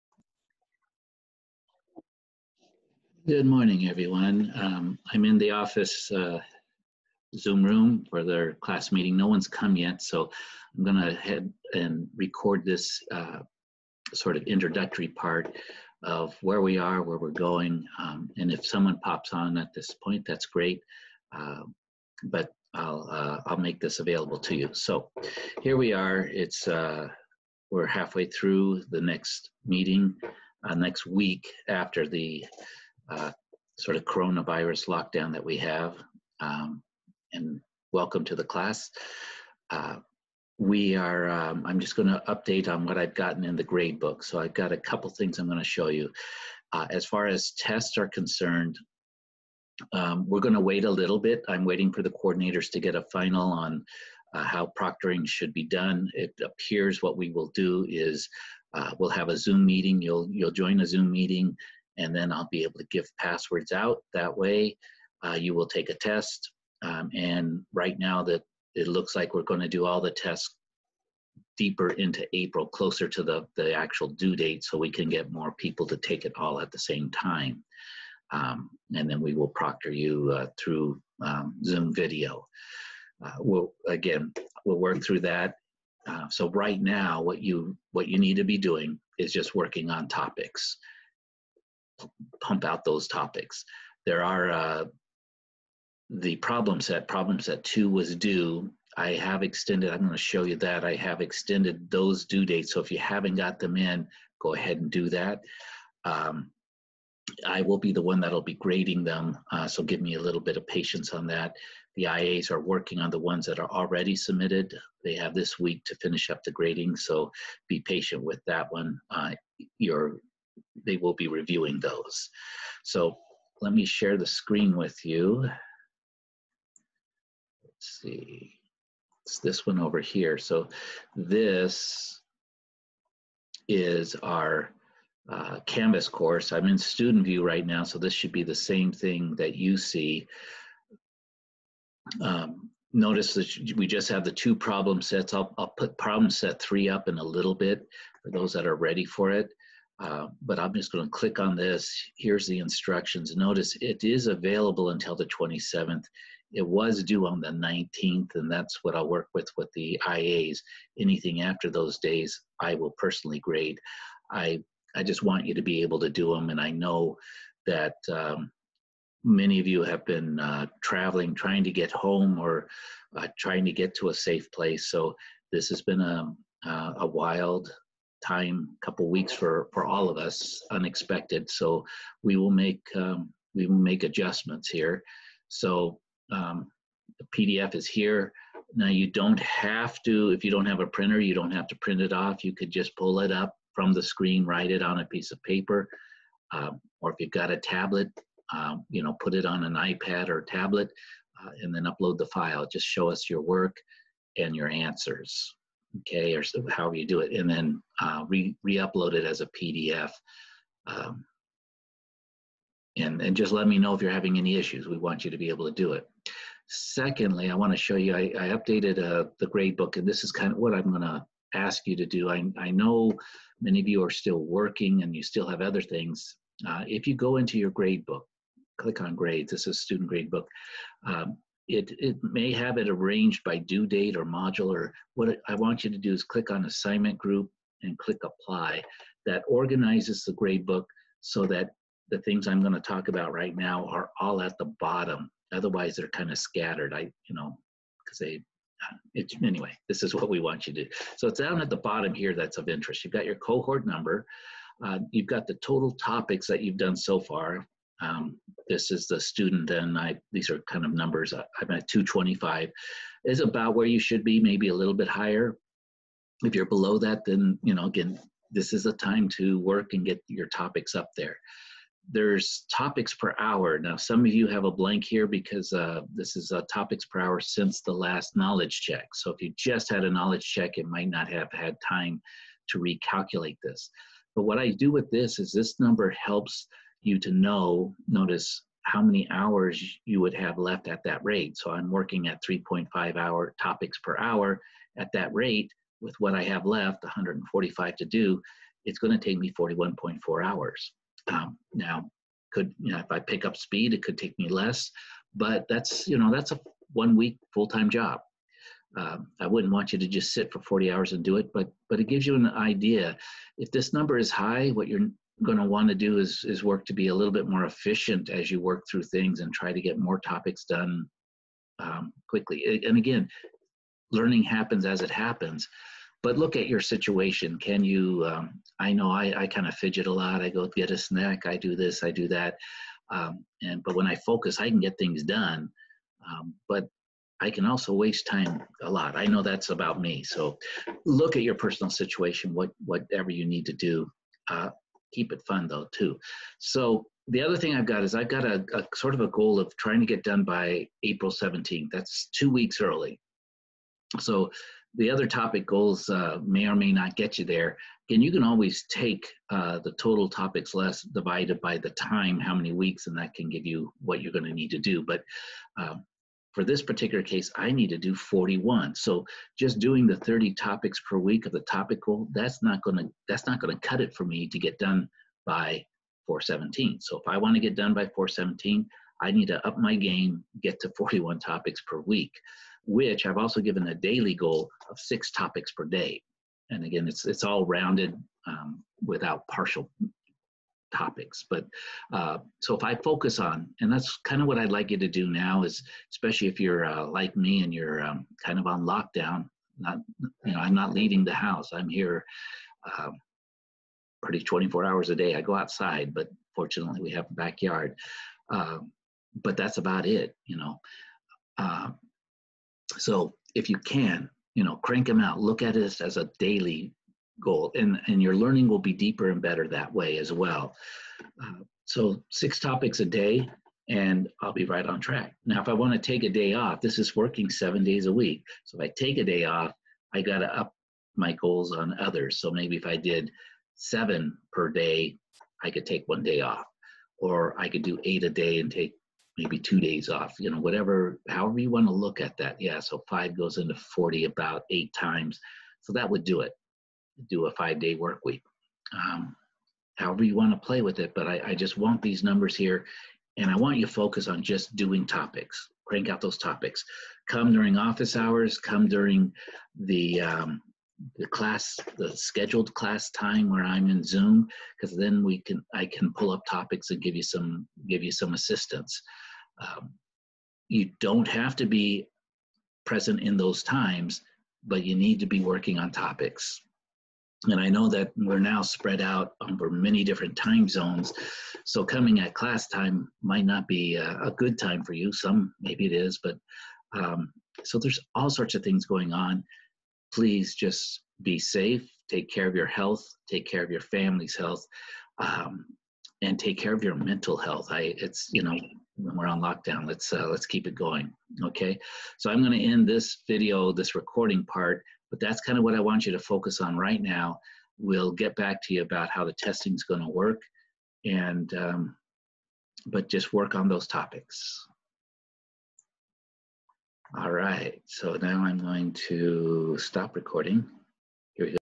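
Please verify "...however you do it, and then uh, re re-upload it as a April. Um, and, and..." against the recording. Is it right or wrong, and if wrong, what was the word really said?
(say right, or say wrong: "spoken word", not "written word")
wrong: "PDF", not "April".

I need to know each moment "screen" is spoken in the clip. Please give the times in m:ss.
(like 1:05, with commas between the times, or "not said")
2:04, 3:14.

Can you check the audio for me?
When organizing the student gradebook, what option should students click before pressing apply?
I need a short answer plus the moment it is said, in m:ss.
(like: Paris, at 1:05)
assignment group, at 3:56.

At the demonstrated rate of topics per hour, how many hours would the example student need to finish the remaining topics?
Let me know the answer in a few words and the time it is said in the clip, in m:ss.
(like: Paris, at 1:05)
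41.4 hours, at 4:59.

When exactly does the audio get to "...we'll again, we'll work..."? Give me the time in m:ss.
1:23.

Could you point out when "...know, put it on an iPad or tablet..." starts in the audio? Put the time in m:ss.
3:19.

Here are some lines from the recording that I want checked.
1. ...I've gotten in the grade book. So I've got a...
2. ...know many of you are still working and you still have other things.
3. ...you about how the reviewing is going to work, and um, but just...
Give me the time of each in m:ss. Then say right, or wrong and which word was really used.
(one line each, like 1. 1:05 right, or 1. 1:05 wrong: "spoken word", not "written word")
1. 0:42 right
2. 3:42 right
3. 8:28 wrong: "testing", not "reviewing".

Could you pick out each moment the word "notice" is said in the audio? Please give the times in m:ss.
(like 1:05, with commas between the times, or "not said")
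2:22, 2:33, 4:48.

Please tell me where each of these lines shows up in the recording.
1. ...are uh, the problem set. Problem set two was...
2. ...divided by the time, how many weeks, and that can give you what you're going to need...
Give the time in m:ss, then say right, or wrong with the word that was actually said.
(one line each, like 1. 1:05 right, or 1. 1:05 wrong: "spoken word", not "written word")
1. 1:34 right
2. 6:01 right.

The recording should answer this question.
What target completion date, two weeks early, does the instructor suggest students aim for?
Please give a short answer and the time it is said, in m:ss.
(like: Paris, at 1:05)
April 17th, at 5:51.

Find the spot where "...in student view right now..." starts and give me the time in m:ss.
2:16.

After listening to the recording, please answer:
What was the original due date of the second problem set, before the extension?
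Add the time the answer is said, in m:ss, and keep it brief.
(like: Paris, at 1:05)
the 19th, at 2:37.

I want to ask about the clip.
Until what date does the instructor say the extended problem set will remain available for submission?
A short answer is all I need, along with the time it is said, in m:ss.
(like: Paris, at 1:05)
the 27th, at 2:35.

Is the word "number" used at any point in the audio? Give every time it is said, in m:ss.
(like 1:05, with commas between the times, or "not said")
4:13, 4:20, 4:45, 5:13, 7:32.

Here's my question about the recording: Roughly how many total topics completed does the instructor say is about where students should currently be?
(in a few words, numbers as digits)
225.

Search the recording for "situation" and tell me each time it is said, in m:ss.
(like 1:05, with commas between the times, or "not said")
5:26, 5:41.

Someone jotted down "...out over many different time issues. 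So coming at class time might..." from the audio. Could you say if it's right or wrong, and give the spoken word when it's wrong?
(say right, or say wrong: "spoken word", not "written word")
wrong: "zones", not "issues".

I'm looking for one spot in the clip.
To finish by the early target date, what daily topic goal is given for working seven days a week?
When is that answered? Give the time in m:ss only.
6:24.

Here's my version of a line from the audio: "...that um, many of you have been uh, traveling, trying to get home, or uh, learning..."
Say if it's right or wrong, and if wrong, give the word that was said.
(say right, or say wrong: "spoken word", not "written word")
wrong: "trying", not "learning".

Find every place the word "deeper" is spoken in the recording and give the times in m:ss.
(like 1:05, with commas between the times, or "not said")
1:11, 6:58.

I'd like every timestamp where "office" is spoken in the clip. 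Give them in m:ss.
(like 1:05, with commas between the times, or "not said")
0:05, 7:37.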